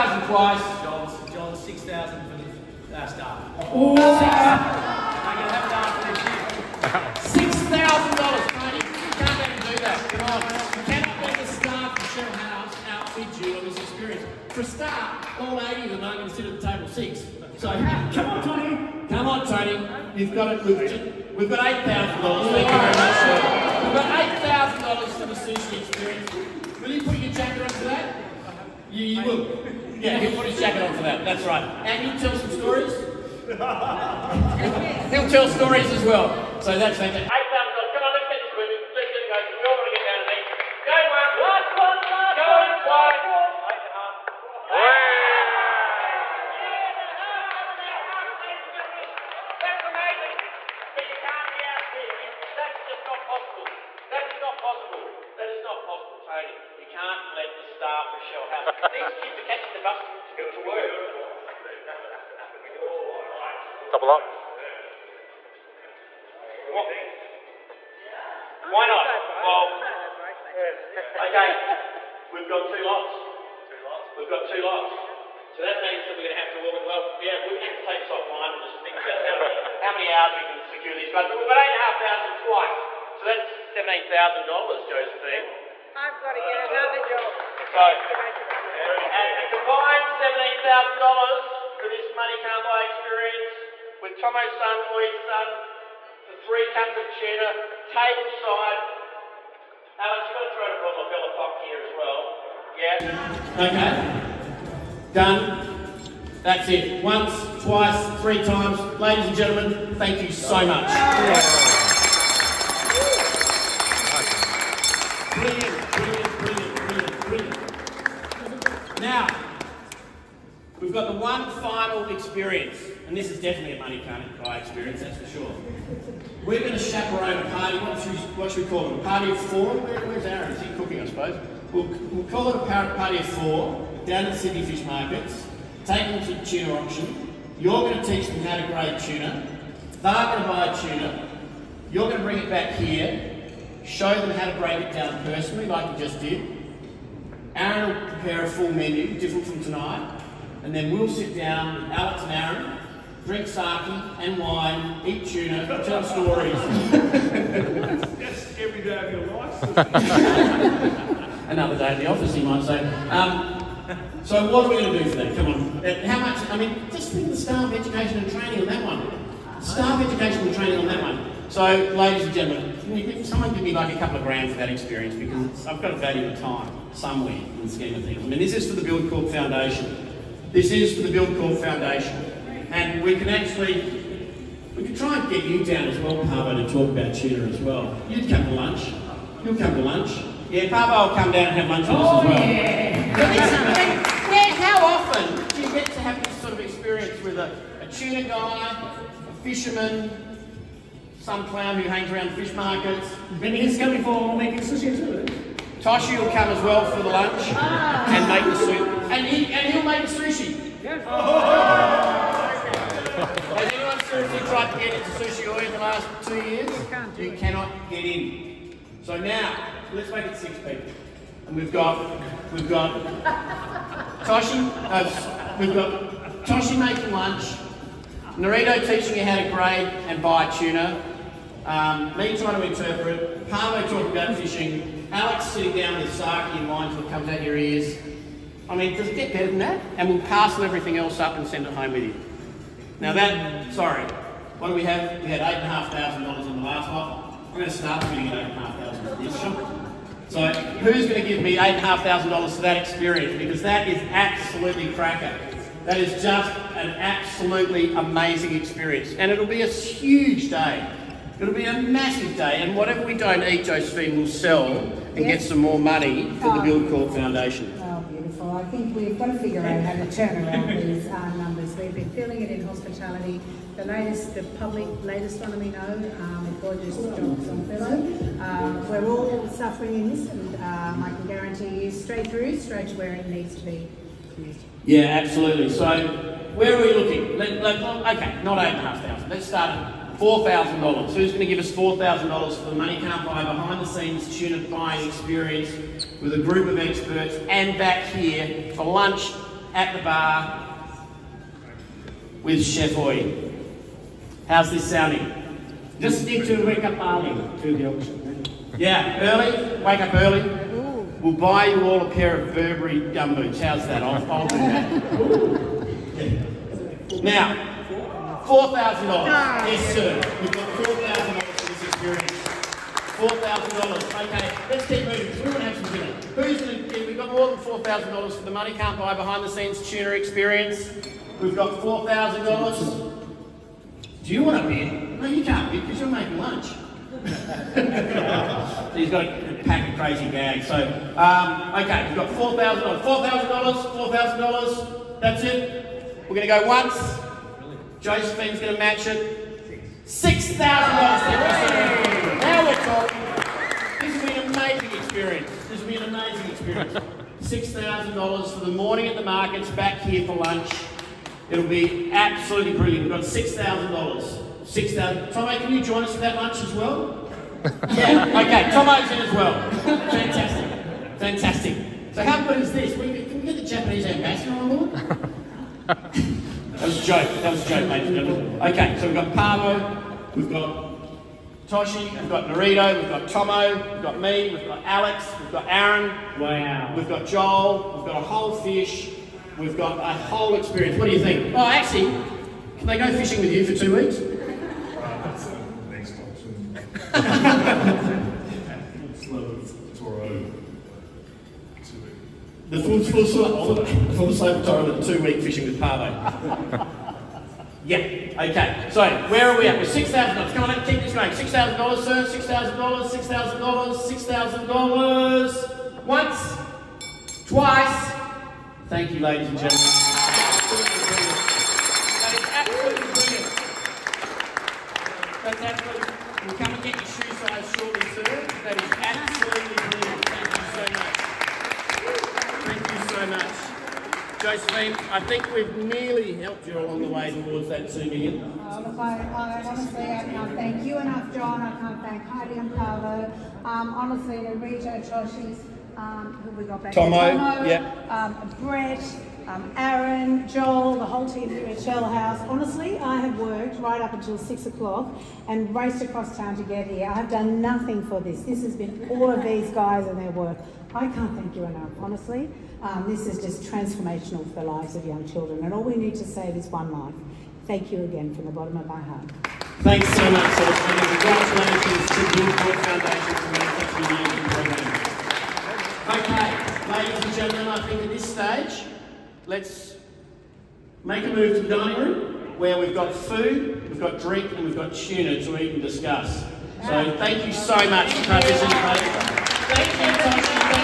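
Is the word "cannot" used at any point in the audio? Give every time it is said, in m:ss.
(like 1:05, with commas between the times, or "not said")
0:10, 3:37.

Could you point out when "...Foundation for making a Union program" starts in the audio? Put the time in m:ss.
7:52.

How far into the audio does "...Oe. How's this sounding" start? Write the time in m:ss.
5:02.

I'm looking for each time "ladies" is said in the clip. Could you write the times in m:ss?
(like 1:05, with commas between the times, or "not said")
1:48, 2:51, 6:17, 6:59, 7:56.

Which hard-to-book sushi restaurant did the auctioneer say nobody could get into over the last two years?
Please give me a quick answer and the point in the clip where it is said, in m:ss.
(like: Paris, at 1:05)
Sushi Oe, at 3:35.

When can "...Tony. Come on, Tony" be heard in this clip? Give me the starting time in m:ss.
0:18.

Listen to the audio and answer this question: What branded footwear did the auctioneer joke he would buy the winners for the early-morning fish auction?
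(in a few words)
Burberry gumboots.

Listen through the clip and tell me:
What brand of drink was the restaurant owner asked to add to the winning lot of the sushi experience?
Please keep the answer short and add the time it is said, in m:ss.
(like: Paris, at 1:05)
Bella Pop, at 1:41.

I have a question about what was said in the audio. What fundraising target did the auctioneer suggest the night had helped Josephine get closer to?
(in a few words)
two million.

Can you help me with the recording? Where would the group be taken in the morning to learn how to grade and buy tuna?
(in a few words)
Sydney Fish Markets.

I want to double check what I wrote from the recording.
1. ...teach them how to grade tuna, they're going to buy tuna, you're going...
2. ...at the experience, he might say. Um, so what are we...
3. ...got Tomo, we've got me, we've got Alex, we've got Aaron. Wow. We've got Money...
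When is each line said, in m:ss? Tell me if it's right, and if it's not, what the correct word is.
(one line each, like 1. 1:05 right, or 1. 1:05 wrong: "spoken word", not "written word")
1. 2:18 right
2. 2:41 wrong: "office", not "experience"
3. 6:23 wrong: "Joel", not "Money".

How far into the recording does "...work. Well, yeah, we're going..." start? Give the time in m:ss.
1:16.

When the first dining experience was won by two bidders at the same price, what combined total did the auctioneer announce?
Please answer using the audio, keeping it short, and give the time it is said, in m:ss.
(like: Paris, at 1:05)
$17,000, at 1:30.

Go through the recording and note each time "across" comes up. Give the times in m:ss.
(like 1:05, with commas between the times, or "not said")
7:36.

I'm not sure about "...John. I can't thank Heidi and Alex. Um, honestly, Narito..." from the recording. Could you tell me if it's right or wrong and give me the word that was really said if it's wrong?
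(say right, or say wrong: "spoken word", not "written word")
wrong: "Paolo", not "Alex".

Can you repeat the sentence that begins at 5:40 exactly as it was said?
So, um, okay, we've got $4,000, $4,000, $4,000.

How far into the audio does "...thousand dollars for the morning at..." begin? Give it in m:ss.
5:57.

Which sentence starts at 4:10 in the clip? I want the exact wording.
So who's going to give me $8,500 for that experience?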